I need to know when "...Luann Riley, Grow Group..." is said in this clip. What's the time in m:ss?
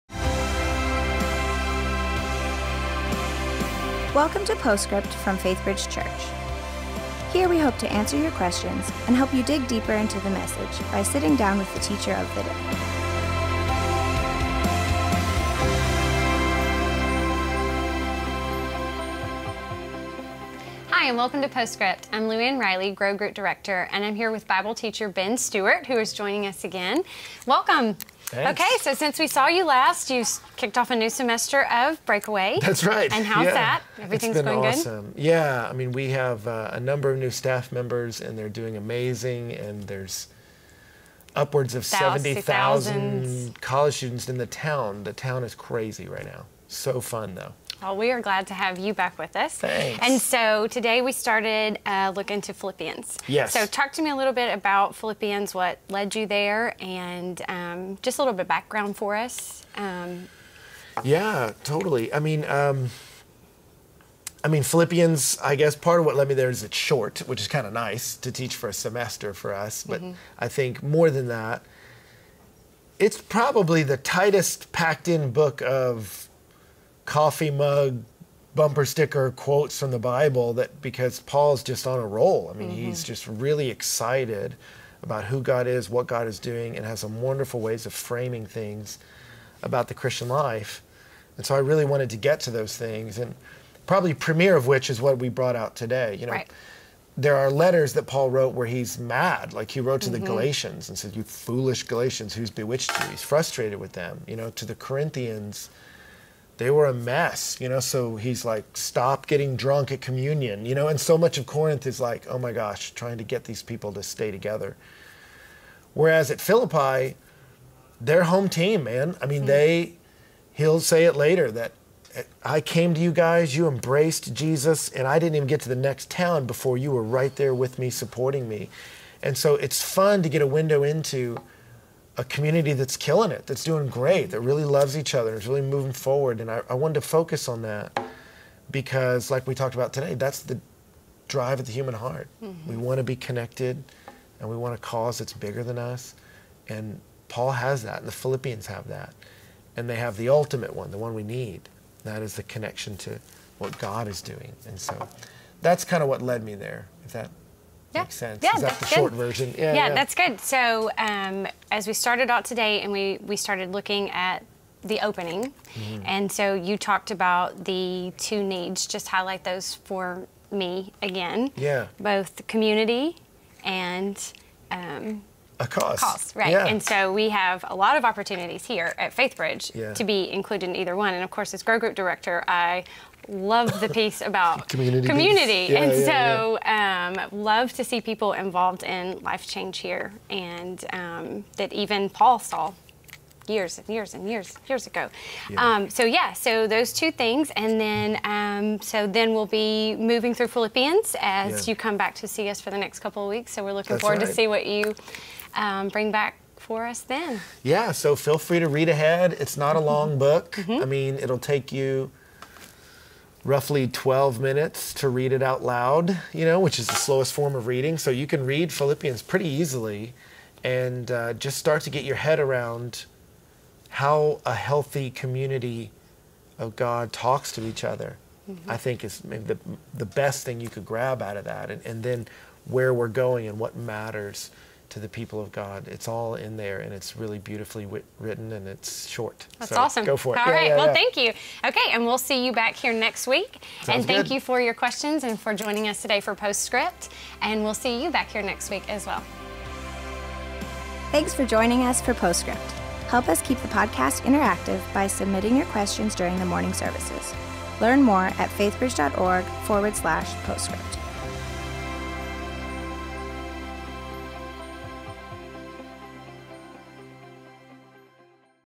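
0:22.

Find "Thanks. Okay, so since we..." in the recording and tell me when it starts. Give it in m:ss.
0:28.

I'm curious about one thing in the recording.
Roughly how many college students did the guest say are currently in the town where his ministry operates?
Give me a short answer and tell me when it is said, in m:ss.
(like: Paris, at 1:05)
70,000, at 0:41.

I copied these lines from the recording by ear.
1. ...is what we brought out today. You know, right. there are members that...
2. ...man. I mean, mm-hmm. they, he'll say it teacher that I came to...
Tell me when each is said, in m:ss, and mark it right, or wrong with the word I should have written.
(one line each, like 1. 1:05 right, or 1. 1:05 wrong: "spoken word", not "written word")
1. 1:34 wrong: "letters", not "members"
2. 1:58 wrong: "later", not "teacher".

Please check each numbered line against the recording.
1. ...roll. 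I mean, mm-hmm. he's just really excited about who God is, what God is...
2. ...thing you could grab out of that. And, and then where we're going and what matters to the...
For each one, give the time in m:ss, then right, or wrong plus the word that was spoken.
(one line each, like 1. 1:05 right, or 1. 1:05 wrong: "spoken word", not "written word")
1. 1:22 right
2. 3:50 right.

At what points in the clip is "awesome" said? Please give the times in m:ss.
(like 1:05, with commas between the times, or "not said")
0:34, 3:59.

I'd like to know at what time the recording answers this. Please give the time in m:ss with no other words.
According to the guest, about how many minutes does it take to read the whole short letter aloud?
3:33.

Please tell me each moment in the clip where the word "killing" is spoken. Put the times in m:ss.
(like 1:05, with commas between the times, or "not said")
2:12.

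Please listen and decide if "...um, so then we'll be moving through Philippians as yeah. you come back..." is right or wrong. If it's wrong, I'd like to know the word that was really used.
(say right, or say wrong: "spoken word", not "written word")
right.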